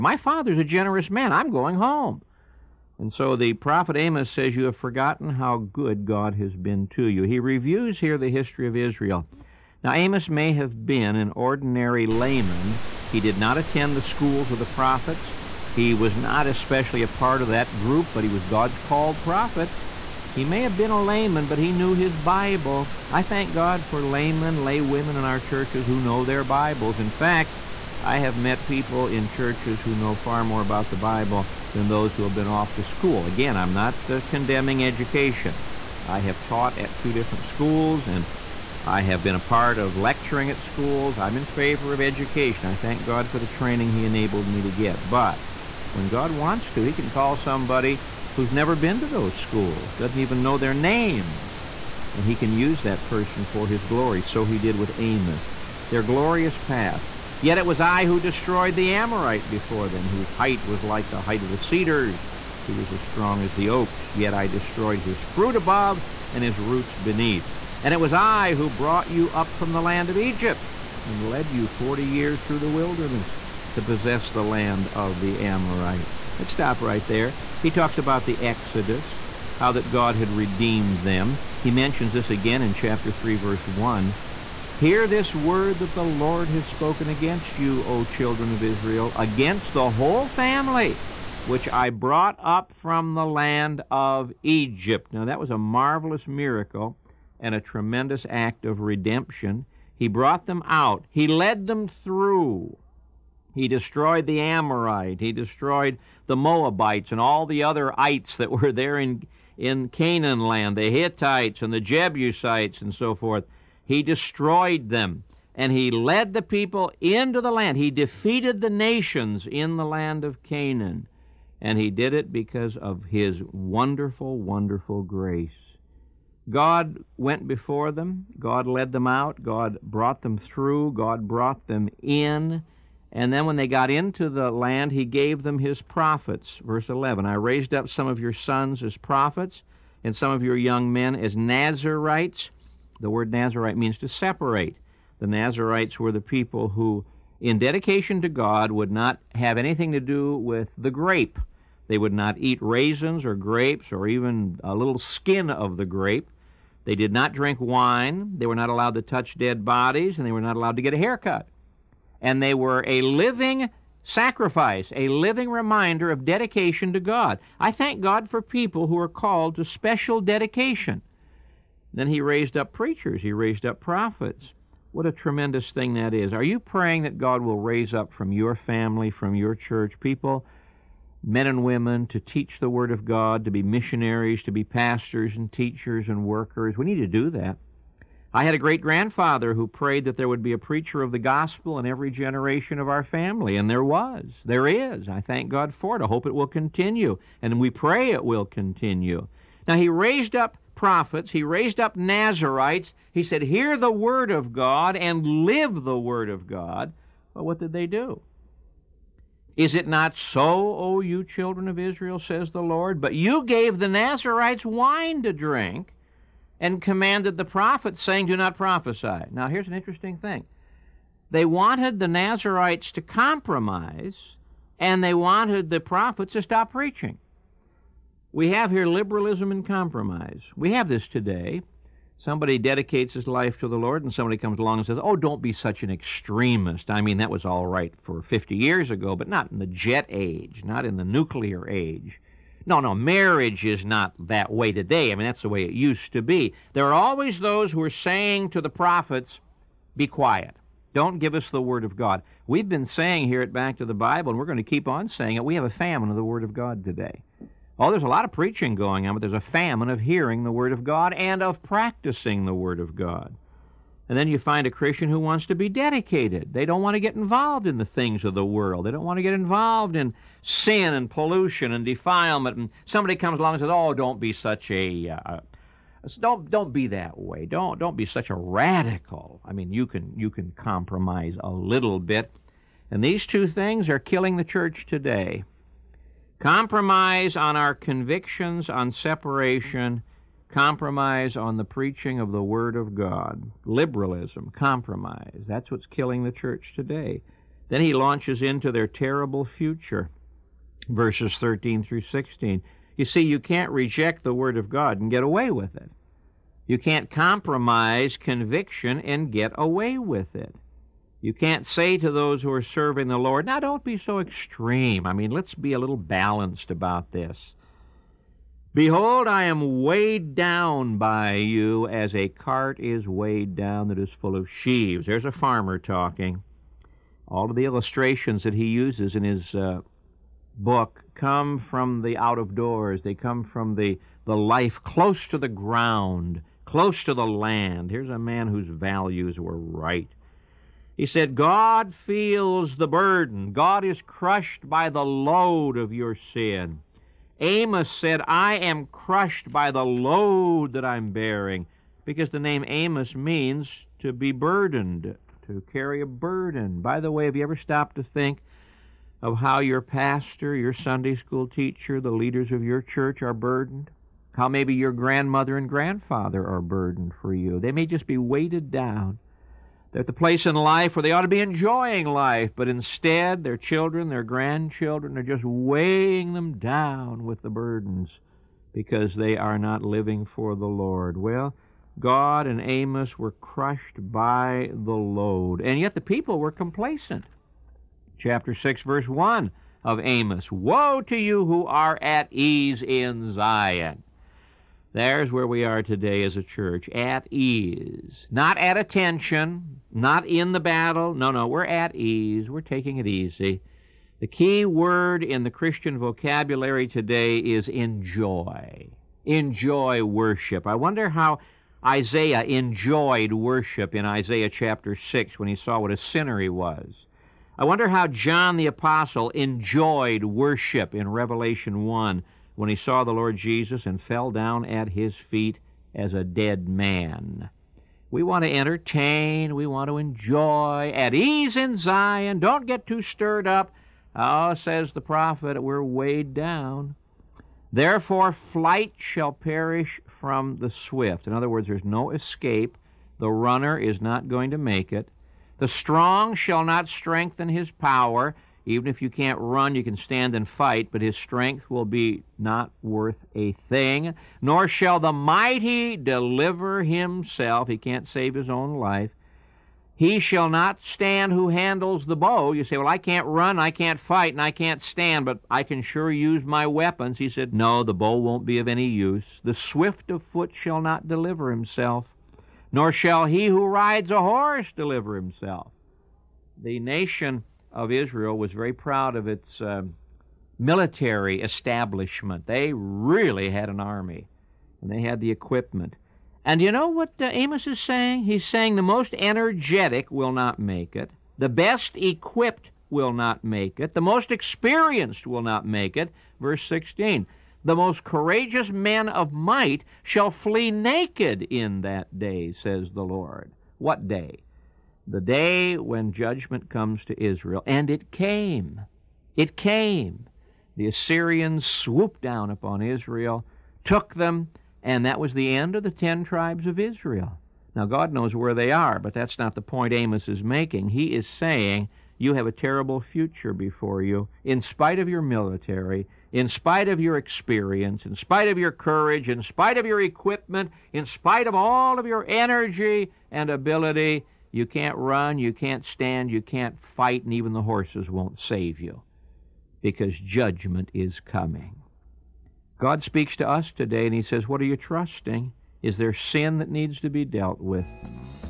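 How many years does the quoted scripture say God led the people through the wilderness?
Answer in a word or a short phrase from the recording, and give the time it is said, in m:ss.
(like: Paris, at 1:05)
40, at 1:11.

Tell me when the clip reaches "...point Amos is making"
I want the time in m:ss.
8:39.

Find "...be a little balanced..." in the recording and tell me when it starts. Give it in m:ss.
5:15.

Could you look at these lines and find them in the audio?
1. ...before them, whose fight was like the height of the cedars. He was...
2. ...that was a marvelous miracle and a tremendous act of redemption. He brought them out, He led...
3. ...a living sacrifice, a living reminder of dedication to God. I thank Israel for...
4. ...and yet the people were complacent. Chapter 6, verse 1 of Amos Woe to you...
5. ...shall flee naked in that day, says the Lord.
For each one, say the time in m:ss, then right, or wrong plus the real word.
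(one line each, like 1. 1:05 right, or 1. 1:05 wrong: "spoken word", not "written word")
1. 0:59 wrong: "height", not "fight"
2. 1:35 right
3. 2:42 wrong: "God", not "Israel"
4. 6:25 right
5. 8:20 right.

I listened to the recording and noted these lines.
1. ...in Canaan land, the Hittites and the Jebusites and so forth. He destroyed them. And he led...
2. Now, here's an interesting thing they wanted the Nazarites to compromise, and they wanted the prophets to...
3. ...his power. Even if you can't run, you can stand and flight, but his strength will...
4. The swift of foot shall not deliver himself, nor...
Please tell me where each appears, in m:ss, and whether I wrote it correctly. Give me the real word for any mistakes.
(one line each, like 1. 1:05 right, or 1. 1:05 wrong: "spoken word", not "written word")
1. 1:49 right
2. 3:39 right
3. 7:27 wrong: "fight", not "flight"
4. 7:49 right.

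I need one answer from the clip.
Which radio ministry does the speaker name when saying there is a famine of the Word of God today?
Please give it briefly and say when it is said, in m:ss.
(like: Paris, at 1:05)
Back to the Bible, at 4:13.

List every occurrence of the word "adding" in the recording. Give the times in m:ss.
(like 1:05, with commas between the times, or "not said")
not said.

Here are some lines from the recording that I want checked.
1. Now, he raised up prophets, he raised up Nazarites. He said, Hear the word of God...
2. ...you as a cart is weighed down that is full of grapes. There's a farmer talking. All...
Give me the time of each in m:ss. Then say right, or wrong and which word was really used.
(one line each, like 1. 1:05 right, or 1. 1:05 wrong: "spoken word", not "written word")
1. 3:19 right
2. 5:21 wrong: "sheaves", not "grapes".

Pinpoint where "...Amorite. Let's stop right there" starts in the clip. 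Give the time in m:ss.
1:15.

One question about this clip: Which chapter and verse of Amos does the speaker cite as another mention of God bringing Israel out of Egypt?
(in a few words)
Chapter 3, verse 1.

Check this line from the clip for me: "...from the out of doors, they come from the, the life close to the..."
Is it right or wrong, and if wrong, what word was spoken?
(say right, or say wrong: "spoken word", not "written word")
right.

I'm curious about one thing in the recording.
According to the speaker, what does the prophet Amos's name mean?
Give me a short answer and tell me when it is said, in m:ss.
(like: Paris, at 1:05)
To be burdened, at 5:54.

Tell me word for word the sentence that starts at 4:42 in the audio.
And these two things are killing the church today.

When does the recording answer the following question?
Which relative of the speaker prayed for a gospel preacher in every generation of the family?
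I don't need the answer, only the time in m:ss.
3:08.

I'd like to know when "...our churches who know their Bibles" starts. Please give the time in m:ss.
0:25.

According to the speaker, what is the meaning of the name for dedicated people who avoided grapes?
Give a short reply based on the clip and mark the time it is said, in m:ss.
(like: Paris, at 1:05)
To separate, at 2:24.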